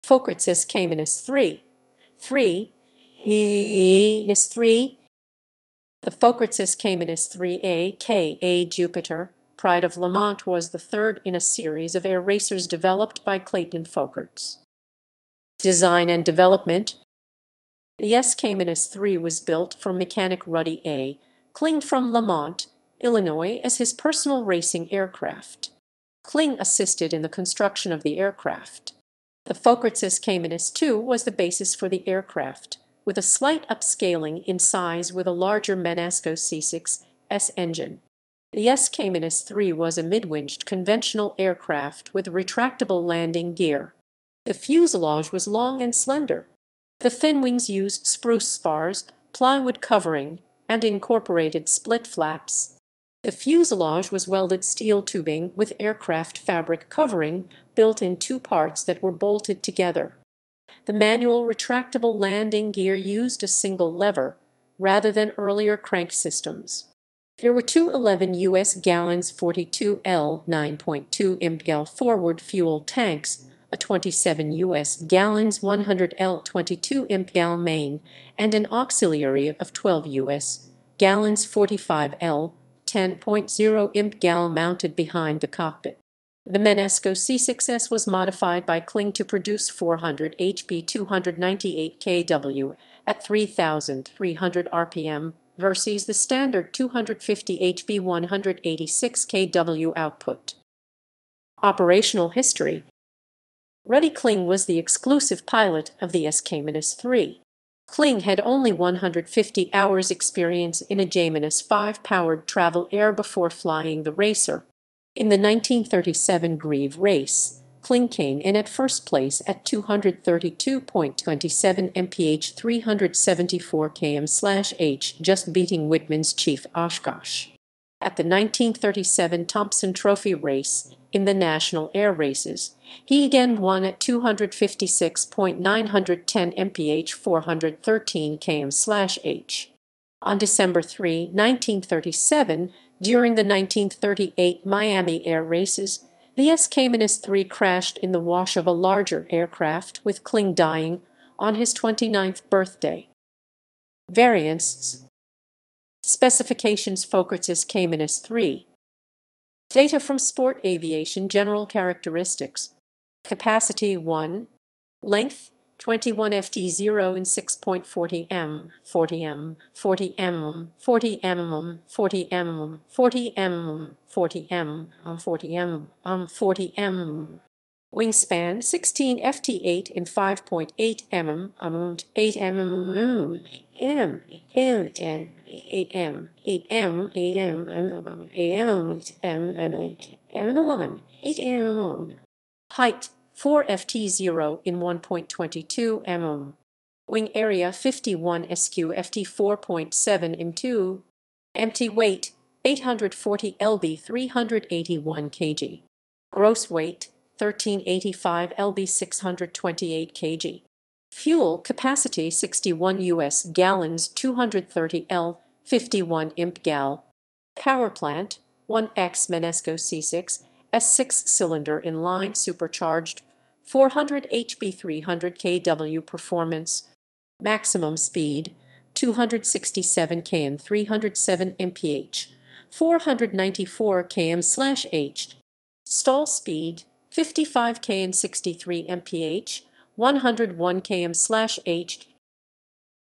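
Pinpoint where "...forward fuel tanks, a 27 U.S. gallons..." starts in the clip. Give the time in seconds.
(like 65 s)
71 s.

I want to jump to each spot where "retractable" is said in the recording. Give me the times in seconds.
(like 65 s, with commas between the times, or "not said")
42 s, 61 s.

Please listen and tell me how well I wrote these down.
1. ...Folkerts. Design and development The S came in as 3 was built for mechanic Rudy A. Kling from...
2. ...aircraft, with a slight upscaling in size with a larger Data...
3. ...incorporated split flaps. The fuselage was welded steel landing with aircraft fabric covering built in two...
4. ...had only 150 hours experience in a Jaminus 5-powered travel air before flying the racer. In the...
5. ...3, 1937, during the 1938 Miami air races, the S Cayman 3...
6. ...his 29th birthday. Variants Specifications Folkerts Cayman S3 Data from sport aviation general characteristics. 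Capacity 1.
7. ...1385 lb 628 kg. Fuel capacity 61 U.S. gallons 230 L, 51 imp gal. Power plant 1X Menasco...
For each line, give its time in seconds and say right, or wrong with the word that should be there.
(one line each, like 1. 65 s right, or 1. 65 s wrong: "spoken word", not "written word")
1. 13 s right
2. 32 s wrong: "Menasco", not "Data"
3. 50 s wrong: "tubing", not "landing"
4. 108 s right
5. 140 s right
6. 151 s right
7. 207 s right.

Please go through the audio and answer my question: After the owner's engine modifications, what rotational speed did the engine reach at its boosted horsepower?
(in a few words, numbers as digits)
3,300 RPM.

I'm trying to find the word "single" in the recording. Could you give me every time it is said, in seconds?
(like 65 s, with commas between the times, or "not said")
63 s.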